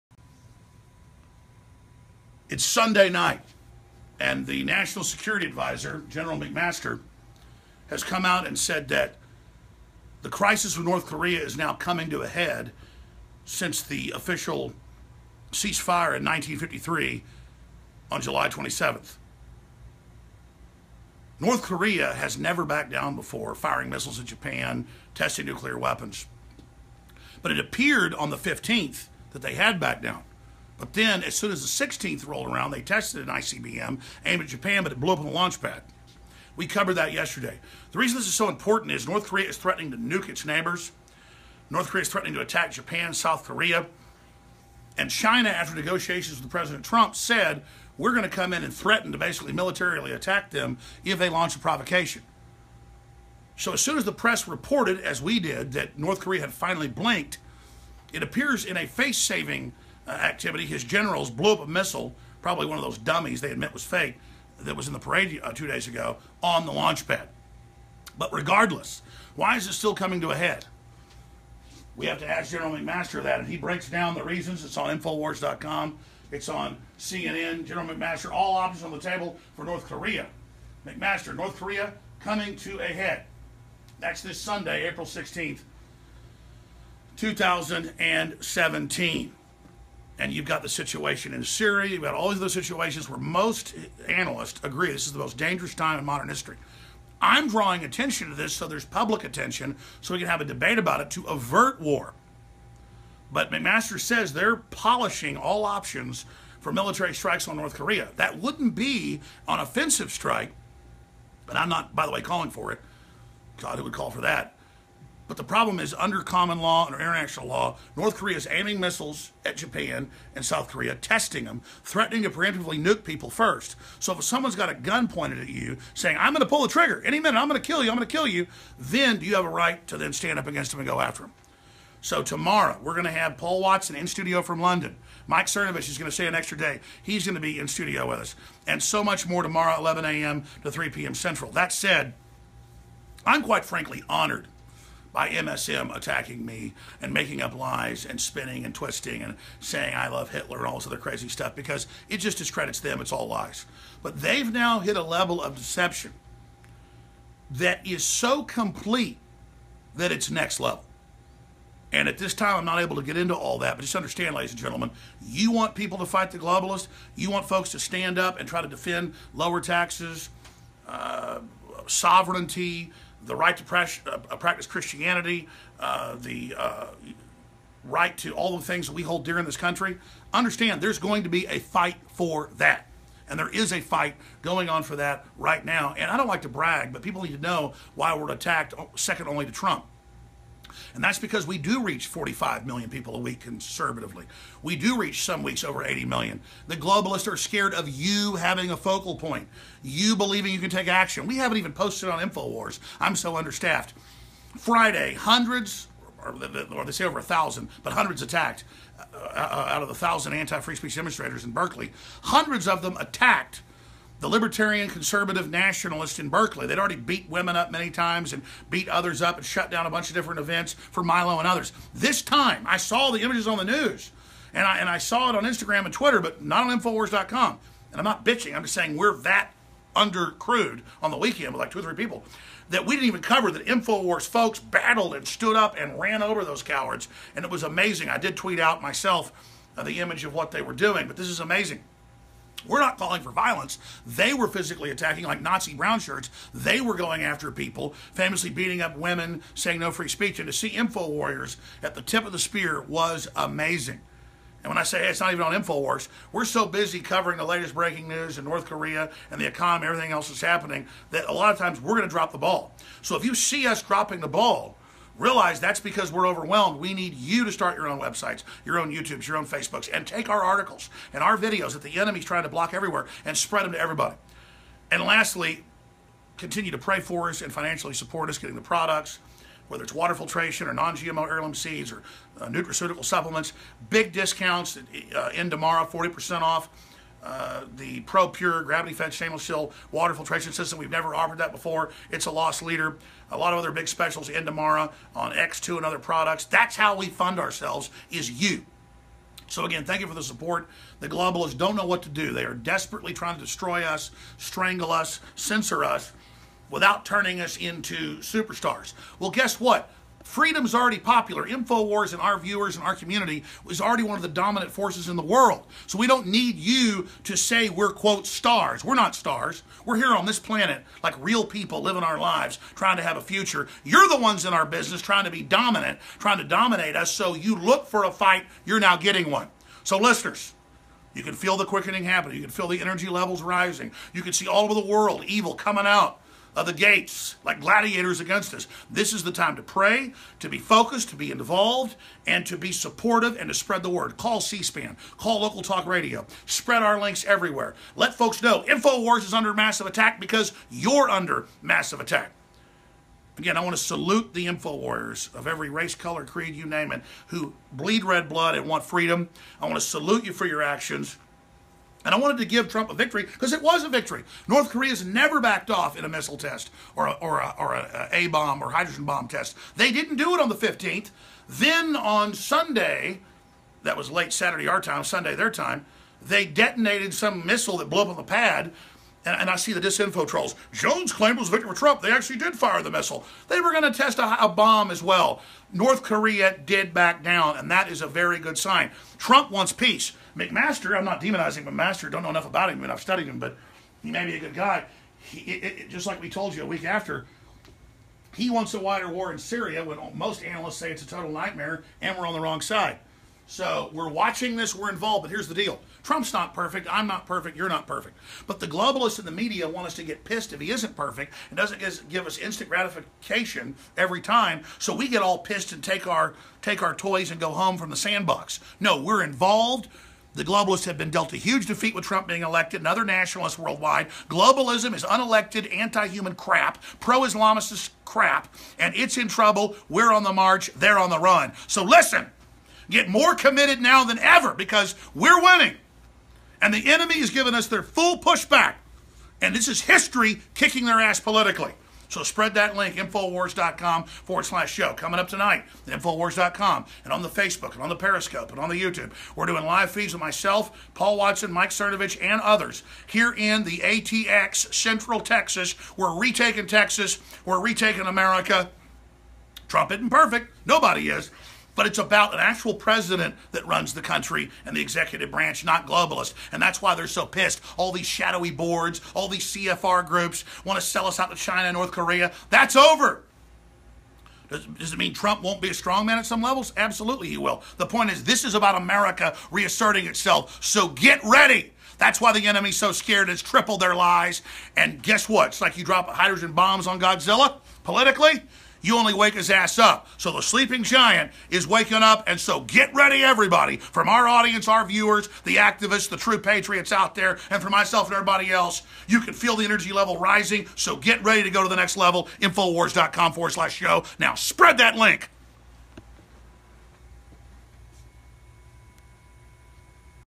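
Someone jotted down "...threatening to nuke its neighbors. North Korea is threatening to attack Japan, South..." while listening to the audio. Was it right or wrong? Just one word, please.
right.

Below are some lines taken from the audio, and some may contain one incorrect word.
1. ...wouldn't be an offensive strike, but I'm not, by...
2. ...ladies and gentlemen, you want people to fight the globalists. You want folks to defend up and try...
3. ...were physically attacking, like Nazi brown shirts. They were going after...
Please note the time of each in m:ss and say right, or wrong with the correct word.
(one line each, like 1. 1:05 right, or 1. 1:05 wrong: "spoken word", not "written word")
1. 1:48 right
2. 2:44 wrong: "stand", not "defend"
3. 4:04 right.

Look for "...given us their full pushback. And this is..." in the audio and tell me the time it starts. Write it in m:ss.
7:17.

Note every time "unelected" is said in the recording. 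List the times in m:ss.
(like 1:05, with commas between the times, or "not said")
7:05.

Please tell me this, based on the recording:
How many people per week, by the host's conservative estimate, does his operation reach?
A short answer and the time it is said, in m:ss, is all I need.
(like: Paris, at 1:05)
45 million, at 3:12.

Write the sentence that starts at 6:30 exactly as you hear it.
McMaster, I'm not demonizing McMaster, don't know enough about him, and I've studied him, but he may be a good guy.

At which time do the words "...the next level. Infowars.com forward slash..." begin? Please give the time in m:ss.
8:21.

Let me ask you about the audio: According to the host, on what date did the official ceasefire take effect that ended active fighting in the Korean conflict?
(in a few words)
July 27th.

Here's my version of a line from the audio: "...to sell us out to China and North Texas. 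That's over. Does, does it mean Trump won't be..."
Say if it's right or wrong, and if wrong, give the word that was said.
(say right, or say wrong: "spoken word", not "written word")
wrong: "Korea", not "Texas".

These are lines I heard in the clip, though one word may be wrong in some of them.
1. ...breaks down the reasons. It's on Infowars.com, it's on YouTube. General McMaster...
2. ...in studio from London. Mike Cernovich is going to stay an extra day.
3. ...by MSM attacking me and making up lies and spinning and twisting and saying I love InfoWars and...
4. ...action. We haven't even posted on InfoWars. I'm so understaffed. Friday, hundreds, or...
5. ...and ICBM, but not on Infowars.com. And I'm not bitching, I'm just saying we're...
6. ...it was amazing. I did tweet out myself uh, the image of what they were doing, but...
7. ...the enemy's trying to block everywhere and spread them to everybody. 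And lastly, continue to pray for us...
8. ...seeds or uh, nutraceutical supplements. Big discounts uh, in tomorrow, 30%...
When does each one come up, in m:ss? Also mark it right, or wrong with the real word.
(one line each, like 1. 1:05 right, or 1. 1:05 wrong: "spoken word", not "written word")
1. 1:13 wrong: "CNN", not "YouTube"
2. 2:13 right
3. 2:25 wrong: "Hitler", not "InfoWars"
4. 3:20 right
5. 3:45 wrong: "Twitter", not "ICBM"
6. 3:57 right
7. 4:31 right
8. 4:41 wrong: "40", not "30".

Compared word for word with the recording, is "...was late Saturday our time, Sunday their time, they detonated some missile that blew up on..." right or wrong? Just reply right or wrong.
right.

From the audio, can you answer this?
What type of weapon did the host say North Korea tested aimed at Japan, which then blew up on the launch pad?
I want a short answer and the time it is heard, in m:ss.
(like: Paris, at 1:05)
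ICBM, at 0:33.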